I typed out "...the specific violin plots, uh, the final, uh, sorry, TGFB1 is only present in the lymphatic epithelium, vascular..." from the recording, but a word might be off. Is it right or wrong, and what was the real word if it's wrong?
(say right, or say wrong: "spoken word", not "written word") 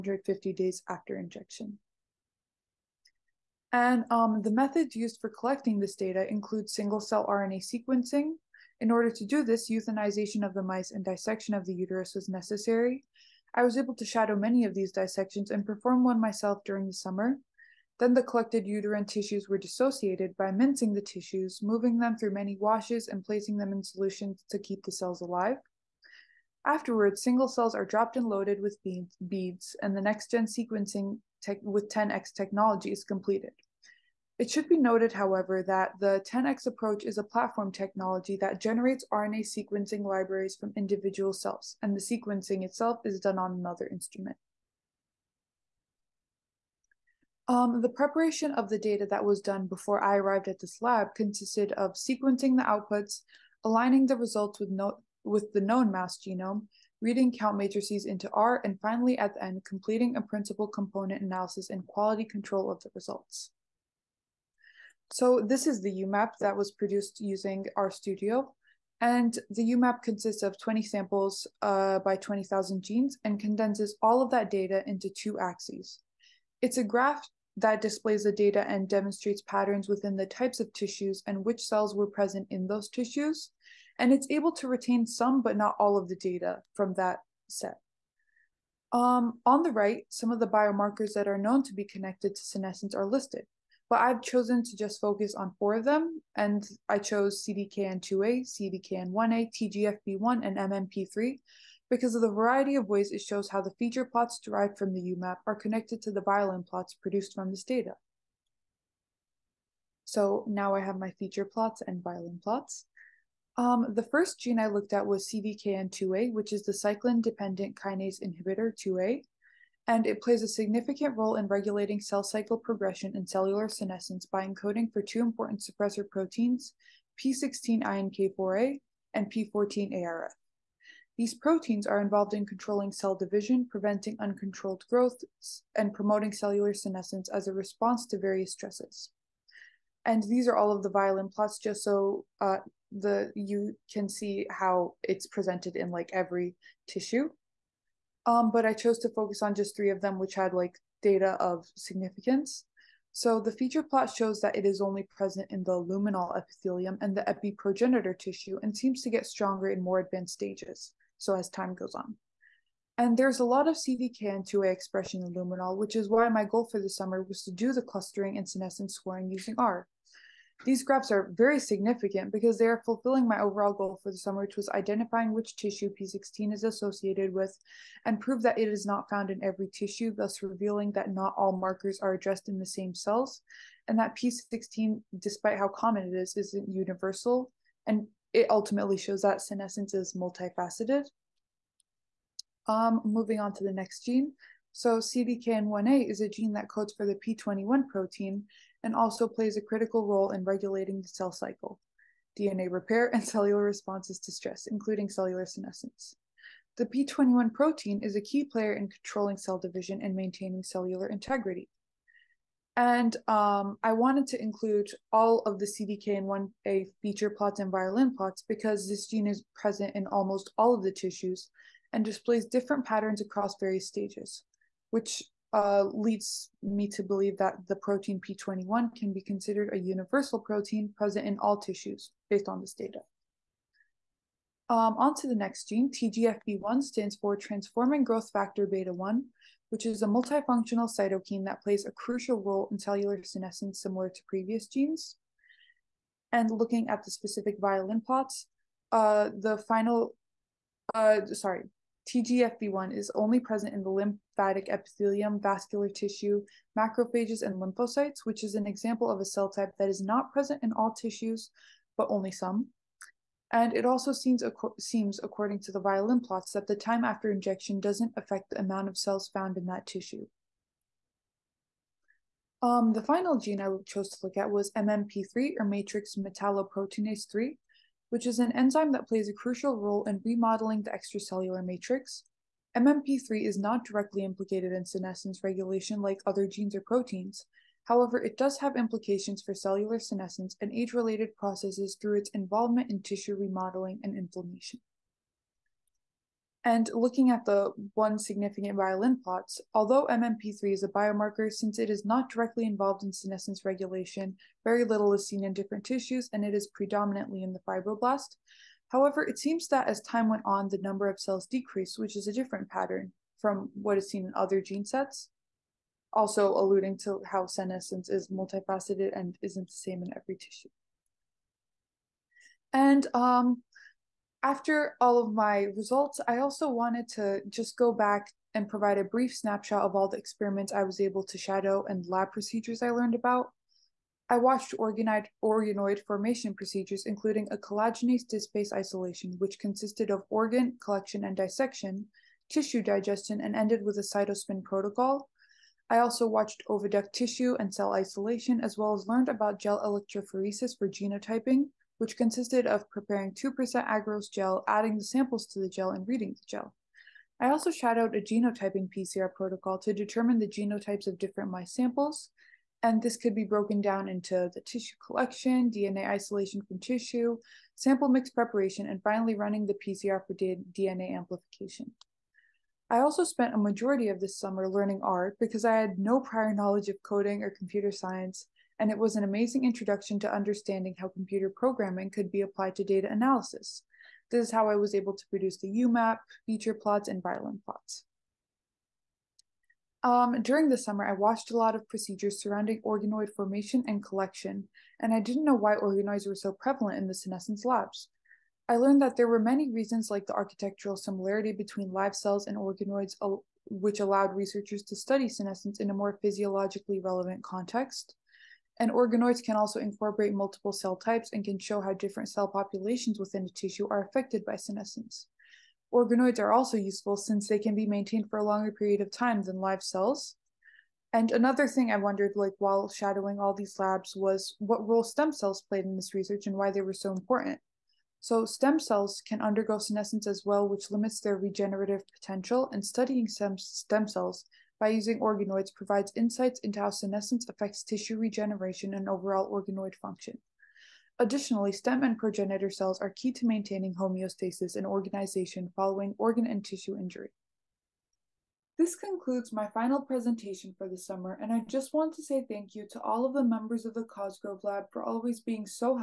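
right.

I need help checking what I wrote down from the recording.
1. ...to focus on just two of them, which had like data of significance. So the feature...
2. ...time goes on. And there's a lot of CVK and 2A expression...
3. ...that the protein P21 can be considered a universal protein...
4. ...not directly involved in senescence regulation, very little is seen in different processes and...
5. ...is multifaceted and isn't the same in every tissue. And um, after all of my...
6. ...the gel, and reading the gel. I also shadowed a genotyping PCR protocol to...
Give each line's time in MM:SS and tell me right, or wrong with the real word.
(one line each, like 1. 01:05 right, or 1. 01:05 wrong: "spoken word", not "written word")
1. 02:28 wrong: "three", not "two"
2. 02:41 right
3. 03:47 right
4. 05:02 wrong: "tissues", not "processes"
5. 05:18 right
6. 05:55 right.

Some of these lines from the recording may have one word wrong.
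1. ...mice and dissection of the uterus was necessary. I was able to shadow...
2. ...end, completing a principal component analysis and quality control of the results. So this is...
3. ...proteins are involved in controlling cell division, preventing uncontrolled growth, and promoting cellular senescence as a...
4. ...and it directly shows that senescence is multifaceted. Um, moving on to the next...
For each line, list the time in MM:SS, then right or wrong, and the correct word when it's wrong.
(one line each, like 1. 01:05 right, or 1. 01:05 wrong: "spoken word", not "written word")
1. 00:10 right
2. 00:59 right
3. 02:11 right
4. 03:07 wrong: "ultimately", not "directly".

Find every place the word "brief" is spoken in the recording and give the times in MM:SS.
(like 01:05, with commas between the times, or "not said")
05:29.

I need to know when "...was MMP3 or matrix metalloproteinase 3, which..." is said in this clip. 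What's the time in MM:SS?
04:34.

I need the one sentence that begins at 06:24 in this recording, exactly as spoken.
This is how I was able to produce the UMAP, feature plots, and violin plots.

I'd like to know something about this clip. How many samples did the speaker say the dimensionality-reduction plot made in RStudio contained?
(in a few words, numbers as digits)
20.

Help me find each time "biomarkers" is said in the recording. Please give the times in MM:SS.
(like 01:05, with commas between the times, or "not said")
01:30, 05:00.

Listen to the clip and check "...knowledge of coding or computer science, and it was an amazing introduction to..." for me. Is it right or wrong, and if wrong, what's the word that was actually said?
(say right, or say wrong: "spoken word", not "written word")
right.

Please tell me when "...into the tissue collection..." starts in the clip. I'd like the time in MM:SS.
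06:04.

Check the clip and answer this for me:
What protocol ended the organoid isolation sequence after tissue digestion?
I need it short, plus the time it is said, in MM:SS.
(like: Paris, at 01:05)
Cytospin, at 05:44.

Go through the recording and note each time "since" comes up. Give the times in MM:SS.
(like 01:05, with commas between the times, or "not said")
05:01, 06:57.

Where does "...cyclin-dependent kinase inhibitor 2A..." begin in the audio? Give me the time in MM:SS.
01:56.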